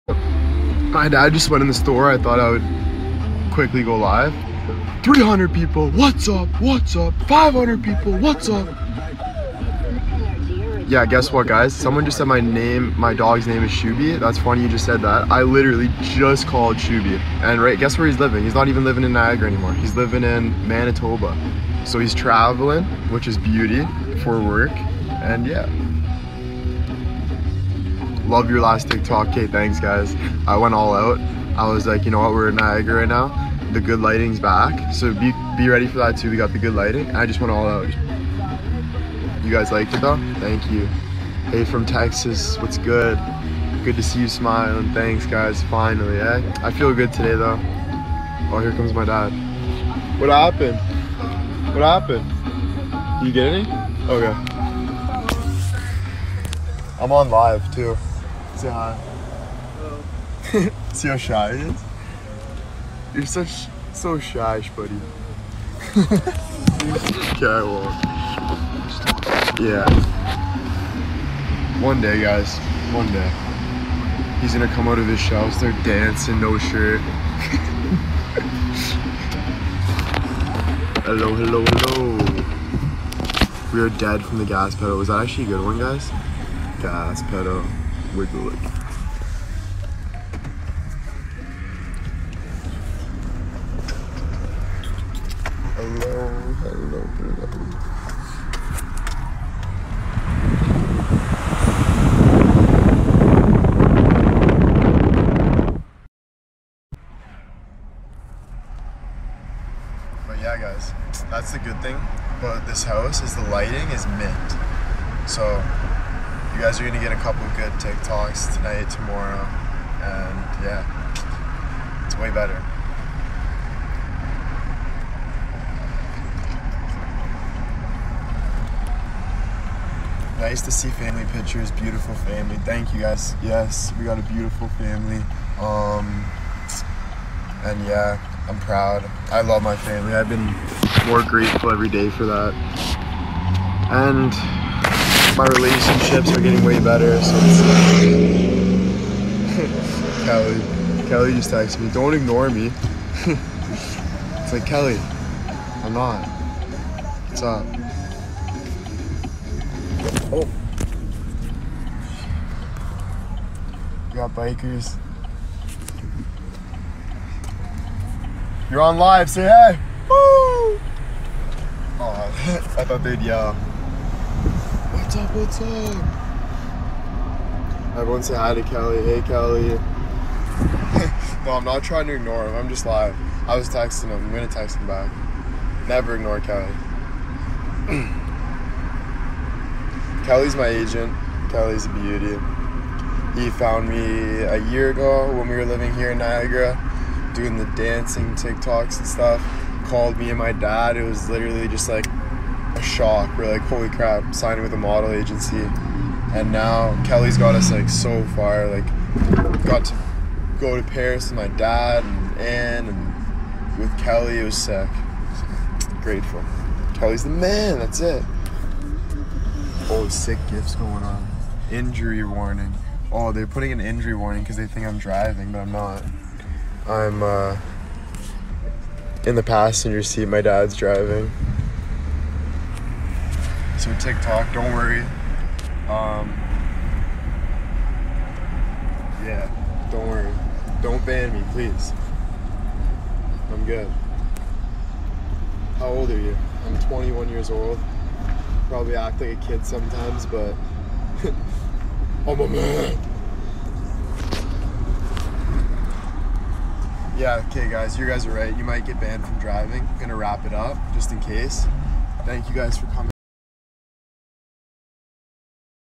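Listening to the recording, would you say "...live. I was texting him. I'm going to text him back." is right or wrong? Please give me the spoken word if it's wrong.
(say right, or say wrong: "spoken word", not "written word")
right.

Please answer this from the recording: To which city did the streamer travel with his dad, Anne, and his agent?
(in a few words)
Paris.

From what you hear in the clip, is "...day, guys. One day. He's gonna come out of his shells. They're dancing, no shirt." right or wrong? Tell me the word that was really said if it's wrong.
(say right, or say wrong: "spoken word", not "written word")
right.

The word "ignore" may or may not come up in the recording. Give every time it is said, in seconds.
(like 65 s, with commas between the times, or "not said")
152 s, 182 s, 186 s.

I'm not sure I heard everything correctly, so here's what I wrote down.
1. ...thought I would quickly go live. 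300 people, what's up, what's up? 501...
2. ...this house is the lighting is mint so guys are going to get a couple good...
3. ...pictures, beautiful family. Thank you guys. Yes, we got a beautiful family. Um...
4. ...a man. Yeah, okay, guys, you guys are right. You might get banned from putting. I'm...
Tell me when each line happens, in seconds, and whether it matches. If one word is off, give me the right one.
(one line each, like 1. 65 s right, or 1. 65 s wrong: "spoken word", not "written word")
1. 2 s wrong: "500", not "501"
2. 112 s right
3. 131 s right
4. 252 s wrong: "driving", not "putting".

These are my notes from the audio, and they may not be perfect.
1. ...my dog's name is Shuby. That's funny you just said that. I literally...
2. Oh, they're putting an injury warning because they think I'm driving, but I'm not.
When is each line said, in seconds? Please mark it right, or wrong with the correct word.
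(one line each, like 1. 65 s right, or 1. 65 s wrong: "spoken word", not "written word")
1. 12 s right
2. 223 s right.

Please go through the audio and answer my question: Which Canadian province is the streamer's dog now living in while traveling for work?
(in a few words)
Manitoba.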